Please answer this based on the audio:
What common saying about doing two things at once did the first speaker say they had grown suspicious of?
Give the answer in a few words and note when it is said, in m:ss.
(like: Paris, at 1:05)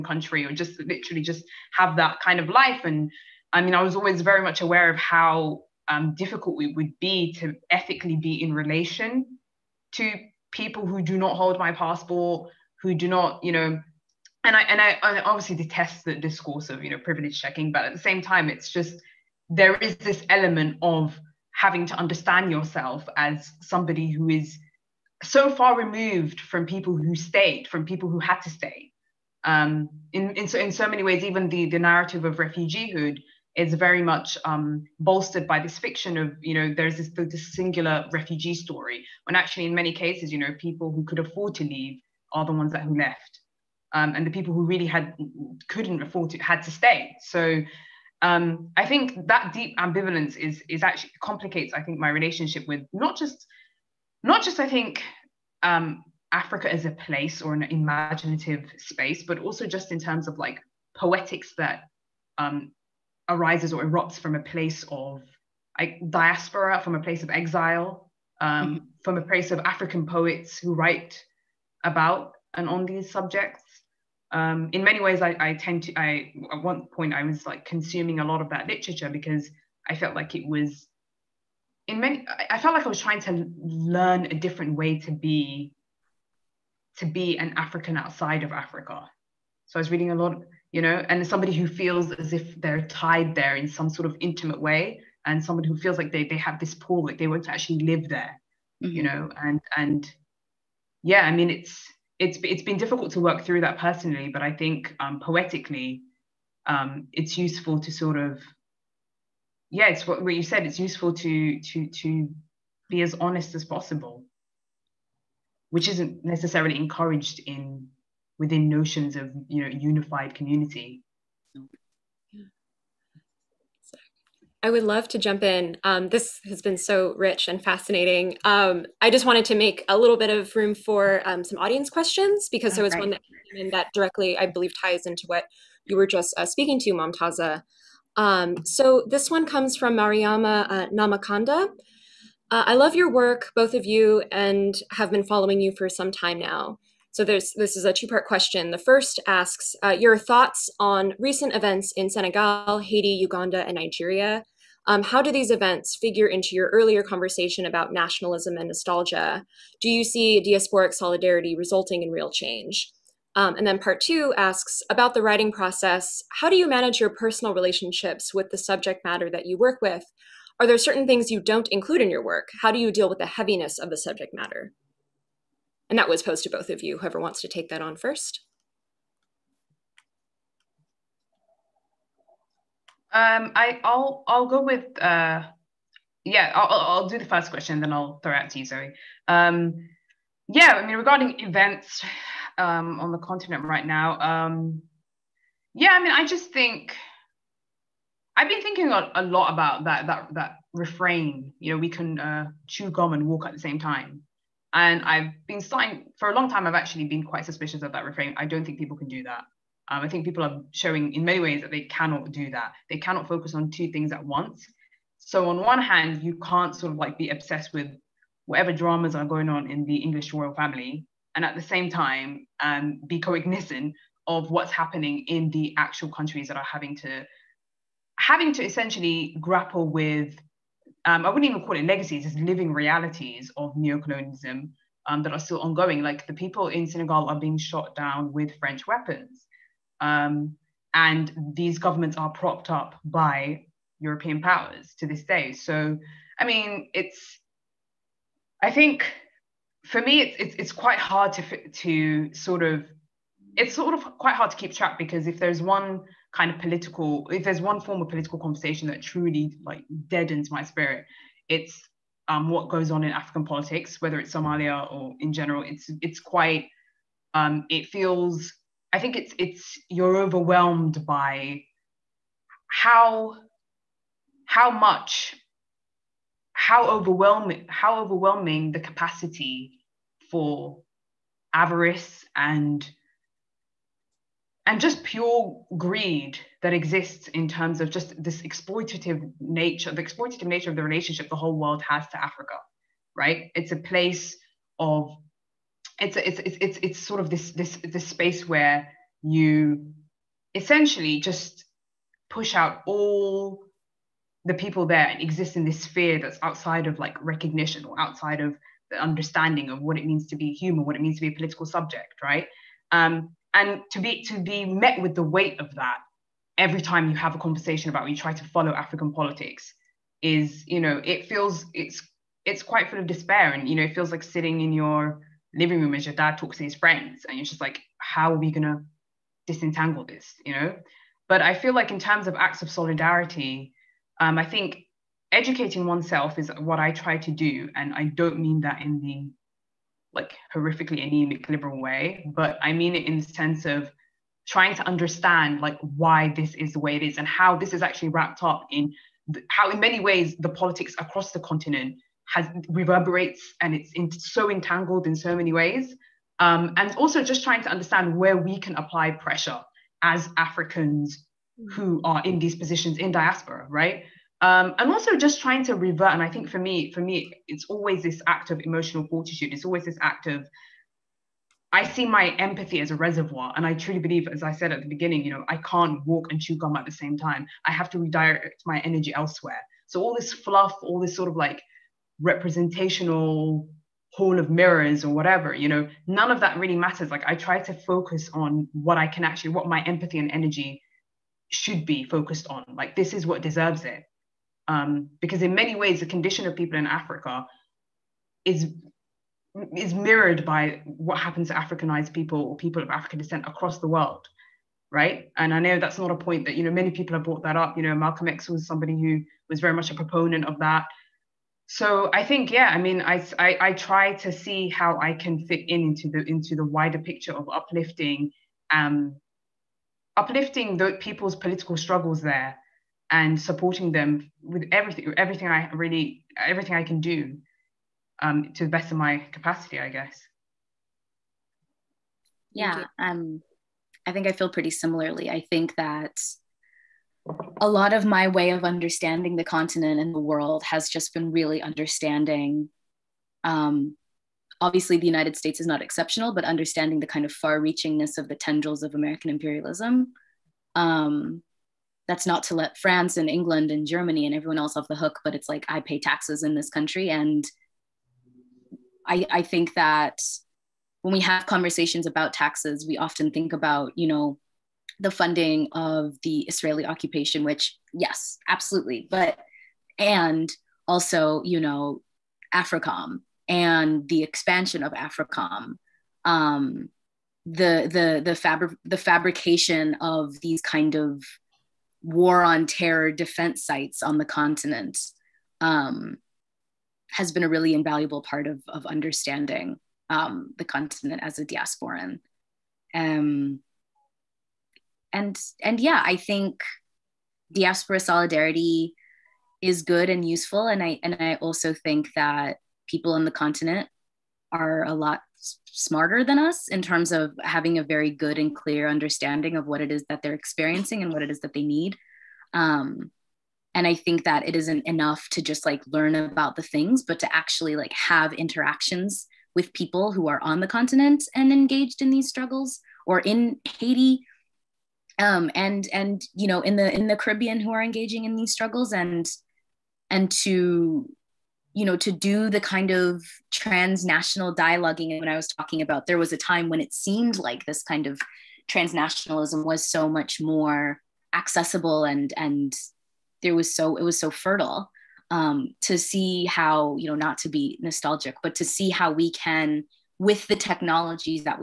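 Chew gum and walk at the same time, at 3:22.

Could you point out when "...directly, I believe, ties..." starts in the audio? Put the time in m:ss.
2:13.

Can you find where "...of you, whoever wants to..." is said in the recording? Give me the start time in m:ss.
2:56.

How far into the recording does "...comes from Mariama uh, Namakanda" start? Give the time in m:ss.
2:19.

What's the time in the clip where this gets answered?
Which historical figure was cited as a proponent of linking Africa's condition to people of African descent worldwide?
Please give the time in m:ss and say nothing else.
6:47.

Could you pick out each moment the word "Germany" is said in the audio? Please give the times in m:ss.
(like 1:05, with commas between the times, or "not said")
7:33.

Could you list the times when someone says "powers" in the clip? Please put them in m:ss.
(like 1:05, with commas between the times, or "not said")
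4:04.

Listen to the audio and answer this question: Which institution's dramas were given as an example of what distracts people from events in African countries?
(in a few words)
English royal family.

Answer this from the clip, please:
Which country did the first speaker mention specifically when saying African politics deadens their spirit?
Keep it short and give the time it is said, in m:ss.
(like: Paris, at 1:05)
Somalia, at 4:24.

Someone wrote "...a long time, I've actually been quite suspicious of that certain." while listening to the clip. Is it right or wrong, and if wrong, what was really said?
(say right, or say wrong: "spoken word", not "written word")
wrong: "refrain", not "certain".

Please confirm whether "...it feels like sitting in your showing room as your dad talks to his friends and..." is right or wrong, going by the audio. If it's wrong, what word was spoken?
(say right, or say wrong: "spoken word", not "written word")
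wrong: "living", not "showing".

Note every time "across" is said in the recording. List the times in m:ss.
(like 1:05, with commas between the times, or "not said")
5:50, 6:43.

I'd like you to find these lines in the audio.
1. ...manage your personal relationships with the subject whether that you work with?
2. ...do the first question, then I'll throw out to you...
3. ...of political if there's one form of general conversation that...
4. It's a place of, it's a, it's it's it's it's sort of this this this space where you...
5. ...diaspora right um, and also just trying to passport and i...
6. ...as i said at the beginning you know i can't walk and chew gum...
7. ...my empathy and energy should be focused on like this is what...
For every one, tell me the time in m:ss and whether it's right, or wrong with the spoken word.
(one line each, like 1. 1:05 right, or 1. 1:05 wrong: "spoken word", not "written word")
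1. 2:46 wrong: "matter", not "whether"
2. 3:07 right
3. 4:16 wrong: "political", not "general"
4. 4:53 right
5. 6:03 wrong: "revert", not "passport"
6. 6:14 right
7. 6:29 right.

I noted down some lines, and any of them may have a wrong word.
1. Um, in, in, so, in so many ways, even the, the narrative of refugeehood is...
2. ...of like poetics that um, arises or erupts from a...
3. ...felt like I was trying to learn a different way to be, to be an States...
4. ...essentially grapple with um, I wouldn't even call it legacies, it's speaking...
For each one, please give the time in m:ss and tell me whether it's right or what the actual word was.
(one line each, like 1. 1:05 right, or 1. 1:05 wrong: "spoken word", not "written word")
1. 0:29 right
2. 1:00 right
3. 1:22 wrong: "African", not "States"
4. 3:48 wrong: "living", not "speaking".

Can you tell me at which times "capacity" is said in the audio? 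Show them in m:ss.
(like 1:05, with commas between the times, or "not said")
4:38, 7:09.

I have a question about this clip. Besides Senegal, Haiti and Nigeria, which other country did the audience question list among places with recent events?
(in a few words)
Uganda.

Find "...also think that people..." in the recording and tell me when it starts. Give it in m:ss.
8:21.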